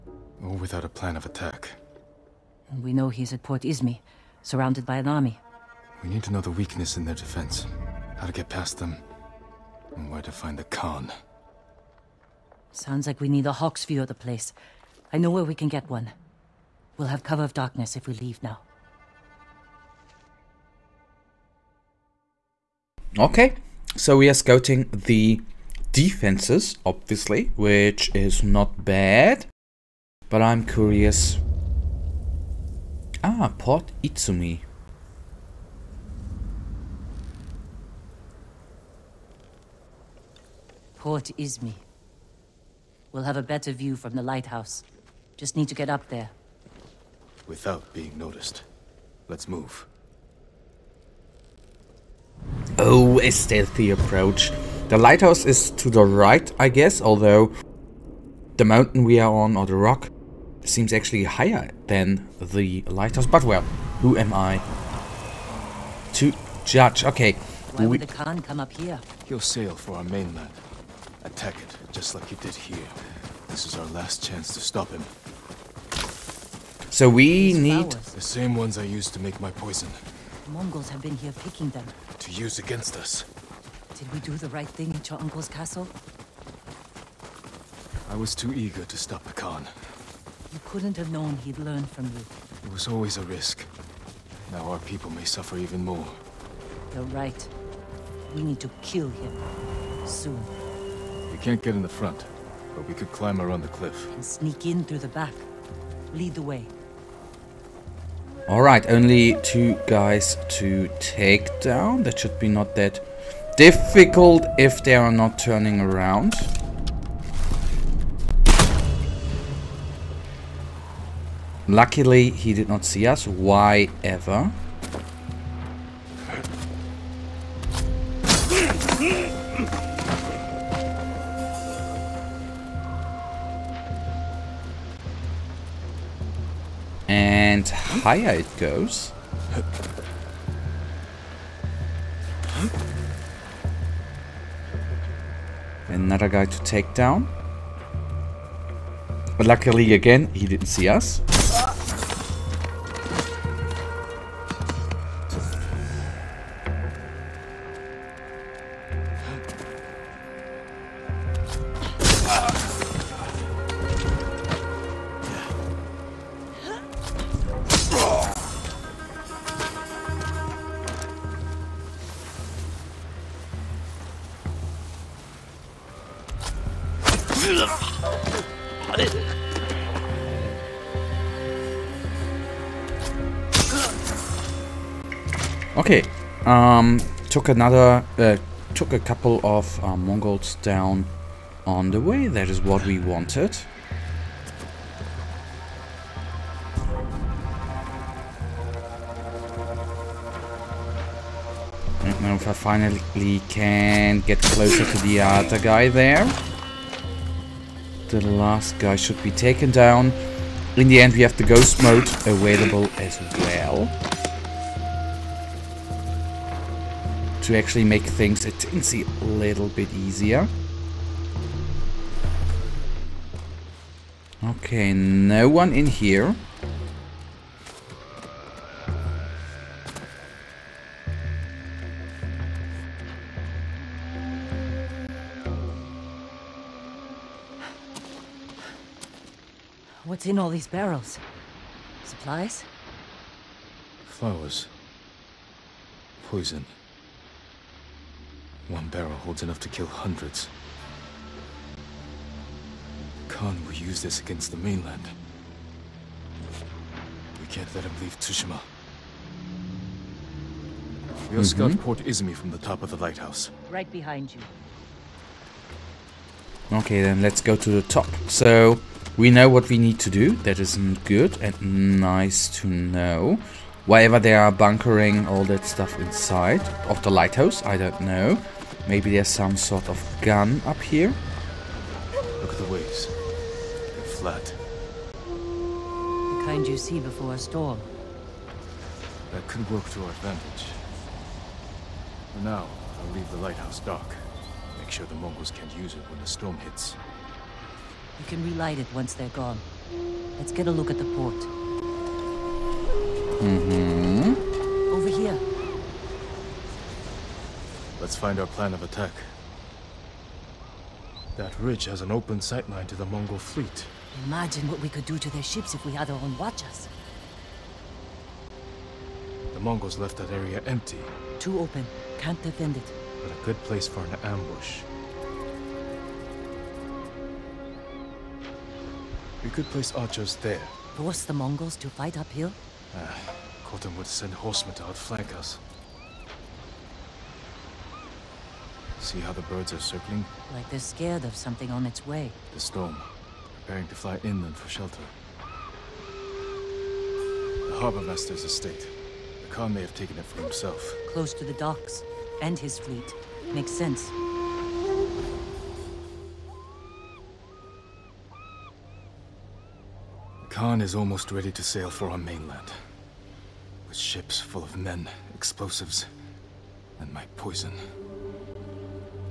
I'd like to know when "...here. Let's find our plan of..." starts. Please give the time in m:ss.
5:05.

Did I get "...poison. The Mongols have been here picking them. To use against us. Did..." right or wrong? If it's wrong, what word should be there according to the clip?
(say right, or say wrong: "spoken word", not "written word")
right.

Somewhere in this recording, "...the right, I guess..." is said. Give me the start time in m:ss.
0:55.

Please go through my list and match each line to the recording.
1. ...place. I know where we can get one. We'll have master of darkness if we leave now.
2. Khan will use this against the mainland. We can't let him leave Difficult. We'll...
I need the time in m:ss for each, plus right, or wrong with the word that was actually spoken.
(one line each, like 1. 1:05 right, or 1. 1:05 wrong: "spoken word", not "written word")
1. 0:14 wrong: "cover", not "master"
2. 4:13 wrong: "Tsushima", not "Difficult".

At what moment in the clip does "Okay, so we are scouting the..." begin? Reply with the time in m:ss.
0:23.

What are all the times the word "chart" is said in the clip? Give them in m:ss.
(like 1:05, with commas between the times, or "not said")
not said.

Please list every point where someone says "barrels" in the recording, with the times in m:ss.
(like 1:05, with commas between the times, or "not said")
4:00, 4:08.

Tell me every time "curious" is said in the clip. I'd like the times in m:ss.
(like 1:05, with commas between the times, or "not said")
0:30.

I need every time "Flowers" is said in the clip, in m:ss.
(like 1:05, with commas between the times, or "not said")
1:17, 4:04.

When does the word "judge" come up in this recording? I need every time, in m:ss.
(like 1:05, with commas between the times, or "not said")
1:06.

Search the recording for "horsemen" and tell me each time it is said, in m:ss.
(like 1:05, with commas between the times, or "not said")
5:34.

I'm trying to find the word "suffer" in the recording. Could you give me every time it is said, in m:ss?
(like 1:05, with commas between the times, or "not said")
1:35.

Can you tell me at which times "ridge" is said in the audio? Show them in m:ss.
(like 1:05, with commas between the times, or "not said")
5:11.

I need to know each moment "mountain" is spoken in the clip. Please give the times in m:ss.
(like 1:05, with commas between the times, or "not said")
0:58.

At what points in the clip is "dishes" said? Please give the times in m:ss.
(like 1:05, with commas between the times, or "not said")
not said.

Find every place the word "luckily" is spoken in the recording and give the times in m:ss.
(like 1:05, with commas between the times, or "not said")
2:01, 2:29.